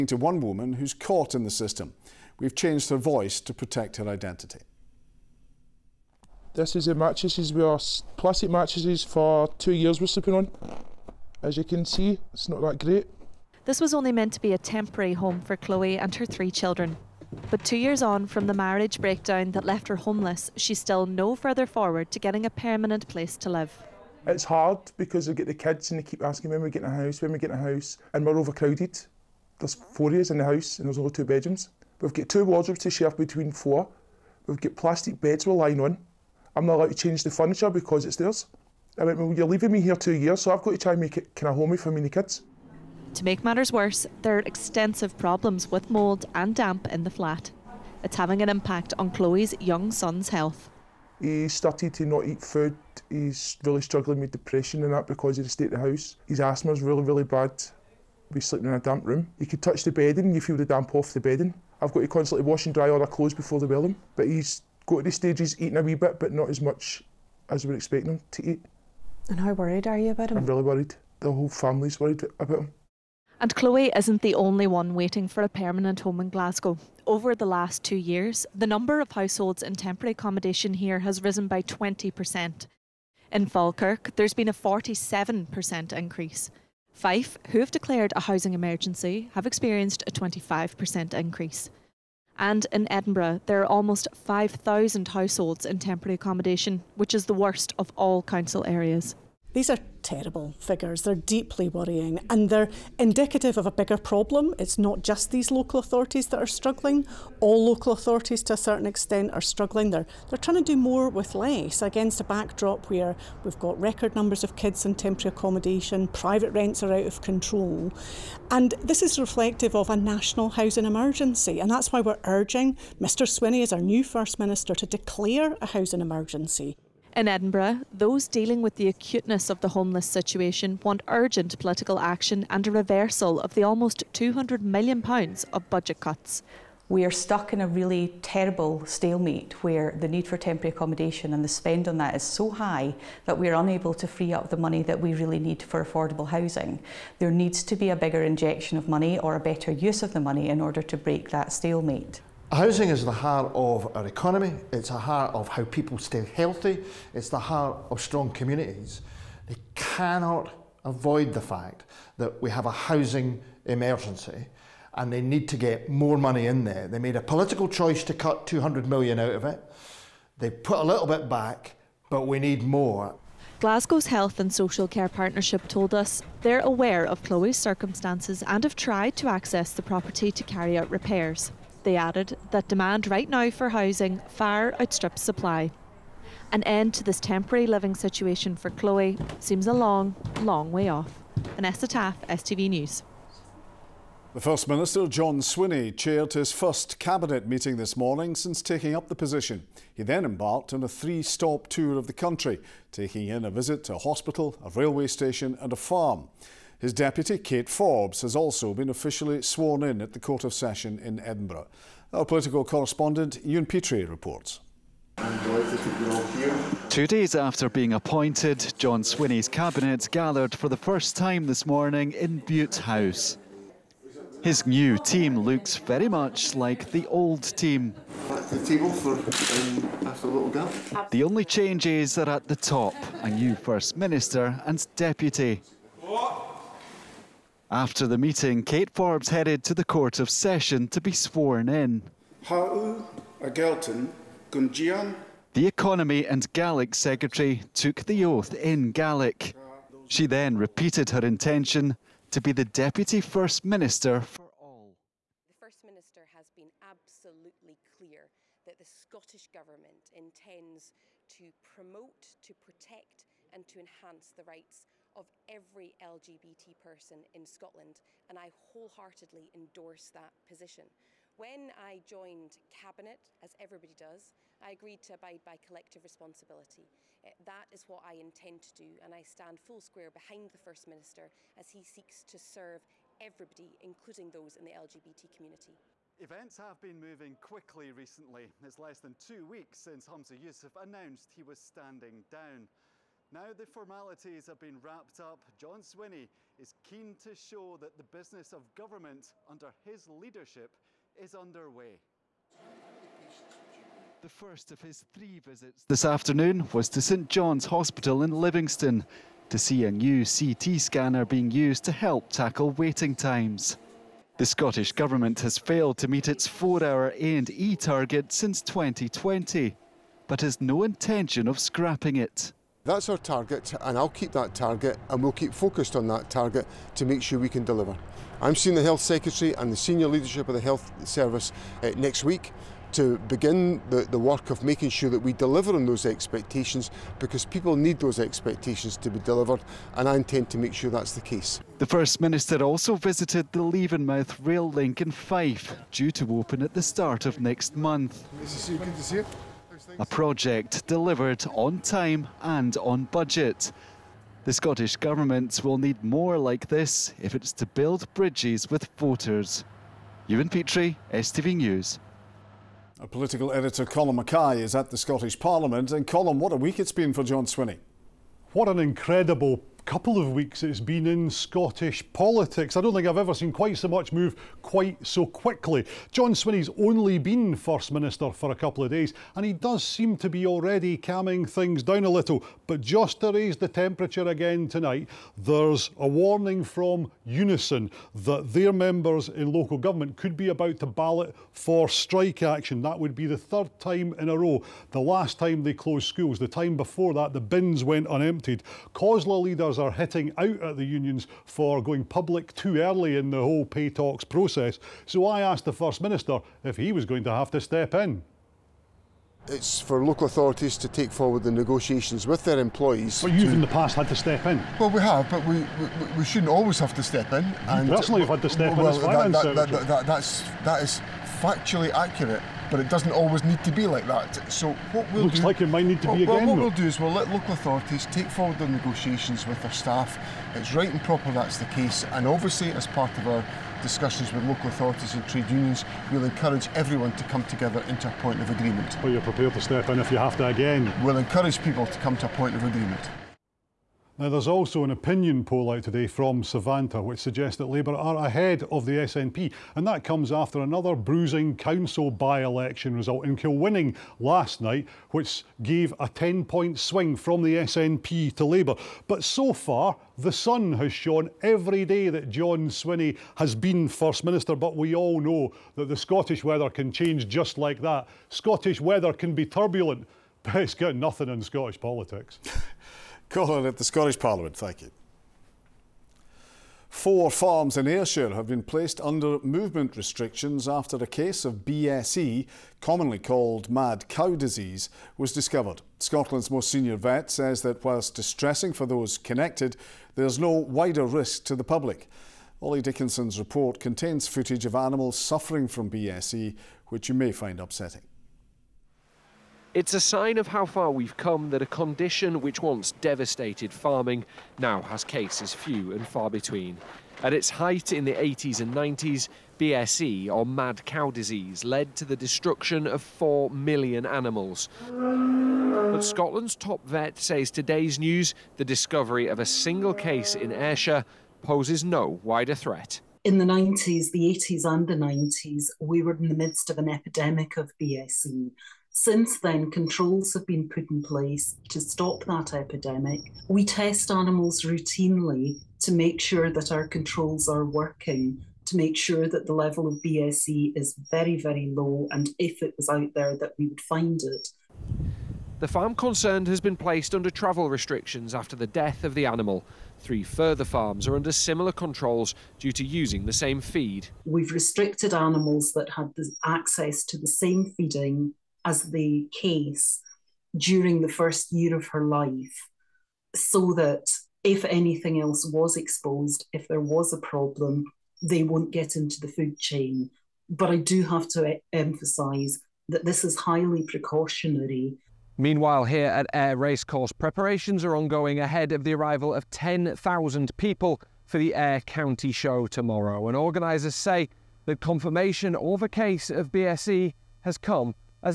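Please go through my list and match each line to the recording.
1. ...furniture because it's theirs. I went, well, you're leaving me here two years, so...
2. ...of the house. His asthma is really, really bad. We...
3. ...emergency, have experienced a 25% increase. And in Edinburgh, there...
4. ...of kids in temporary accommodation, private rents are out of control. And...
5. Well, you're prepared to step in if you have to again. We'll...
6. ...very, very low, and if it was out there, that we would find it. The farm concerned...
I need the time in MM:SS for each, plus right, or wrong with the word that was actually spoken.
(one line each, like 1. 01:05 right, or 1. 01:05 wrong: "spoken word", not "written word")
1. 00:37 right
2. 00:55 right
3. 01:28 right
4. 01:54 right
5. 07:19 right
6. 09:01 right.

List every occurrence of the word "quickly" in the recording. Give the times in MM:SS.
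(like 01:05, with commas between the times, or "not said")
04:47, 06:15.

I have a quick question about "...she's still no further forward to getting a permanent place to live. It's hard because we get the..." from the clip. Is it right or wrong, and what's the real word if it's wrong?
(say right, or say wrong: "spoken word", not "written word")
right.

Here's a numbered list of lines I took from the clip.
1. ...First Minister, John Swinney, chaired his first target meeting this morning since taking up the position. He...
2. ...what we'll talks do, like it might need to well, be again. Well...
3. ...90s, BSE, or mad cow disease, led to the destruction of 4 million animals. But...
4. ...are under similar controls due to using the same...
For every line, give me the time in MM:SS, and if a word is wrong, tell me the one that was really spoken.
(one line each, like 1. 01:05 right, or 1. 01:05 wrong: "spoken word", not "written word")
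1. 03:14 wrong: "cabinet", not "target"
2. 07:04 wrong: "looks", not "talks"
3. 08:28 right
4. 09:11 right.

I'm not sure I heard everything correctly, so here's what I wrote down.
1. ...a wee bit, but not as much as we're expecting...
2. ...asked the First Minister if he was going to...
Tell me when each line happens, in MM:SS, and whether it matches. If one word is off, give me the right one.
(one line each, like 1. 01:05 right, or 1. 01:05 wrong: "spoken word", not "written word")
1. 01:05 right
2. 06:45 right.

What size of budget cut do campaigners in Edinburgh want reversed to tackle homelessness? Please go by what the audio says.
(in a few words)
almost £200 million.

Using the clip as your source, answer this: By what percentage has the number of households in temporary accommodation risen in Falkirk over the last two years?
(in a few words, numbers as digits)
47%.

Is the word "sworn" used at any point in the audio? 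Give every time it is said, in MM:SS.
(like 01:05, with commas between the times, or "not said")
03:29, 04:01.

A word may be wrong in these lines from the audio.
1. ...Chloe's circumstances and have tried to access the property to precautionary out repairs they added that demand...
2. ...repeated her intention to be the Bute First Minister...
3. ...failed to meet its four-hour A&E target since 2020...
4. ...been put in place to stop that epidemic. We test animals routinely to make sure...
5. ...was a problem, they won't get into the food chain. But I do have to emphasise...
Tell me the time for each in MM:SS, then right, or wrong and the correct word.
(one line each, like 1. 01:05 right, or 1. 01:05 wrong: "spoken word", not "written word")
1. 02:57 wrong: "carry", not "precautionary"
2. 04:10 wrong: "Deputy", not "Bute"
3. 05:15 right
4. 08:50 right
5. 09:26 right.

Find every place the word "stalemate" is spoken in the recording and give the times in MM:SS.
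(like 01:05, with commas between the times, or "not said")
02:18, 02:31.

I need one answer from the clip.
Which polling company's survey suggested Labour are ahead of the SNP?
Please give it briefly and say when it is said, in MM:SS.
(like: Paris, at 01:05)
Savanta, at 07:26.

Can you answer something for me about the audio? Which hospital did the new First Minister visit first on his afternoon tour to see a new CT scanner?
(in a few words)
St John's Hospital.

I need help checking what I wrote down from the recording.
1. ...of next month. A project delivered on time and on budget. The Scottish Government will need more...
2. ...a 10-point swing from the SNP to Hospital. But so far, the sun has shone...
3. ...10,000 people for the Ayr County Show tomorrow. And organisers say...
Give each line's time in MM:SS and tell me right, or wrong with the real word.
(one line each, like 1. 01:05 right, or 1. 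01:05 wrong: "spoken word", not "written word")
1. 05:47 right
2. 07:35 wrong: "Labour", not "Hospital"
3. 09:39 right.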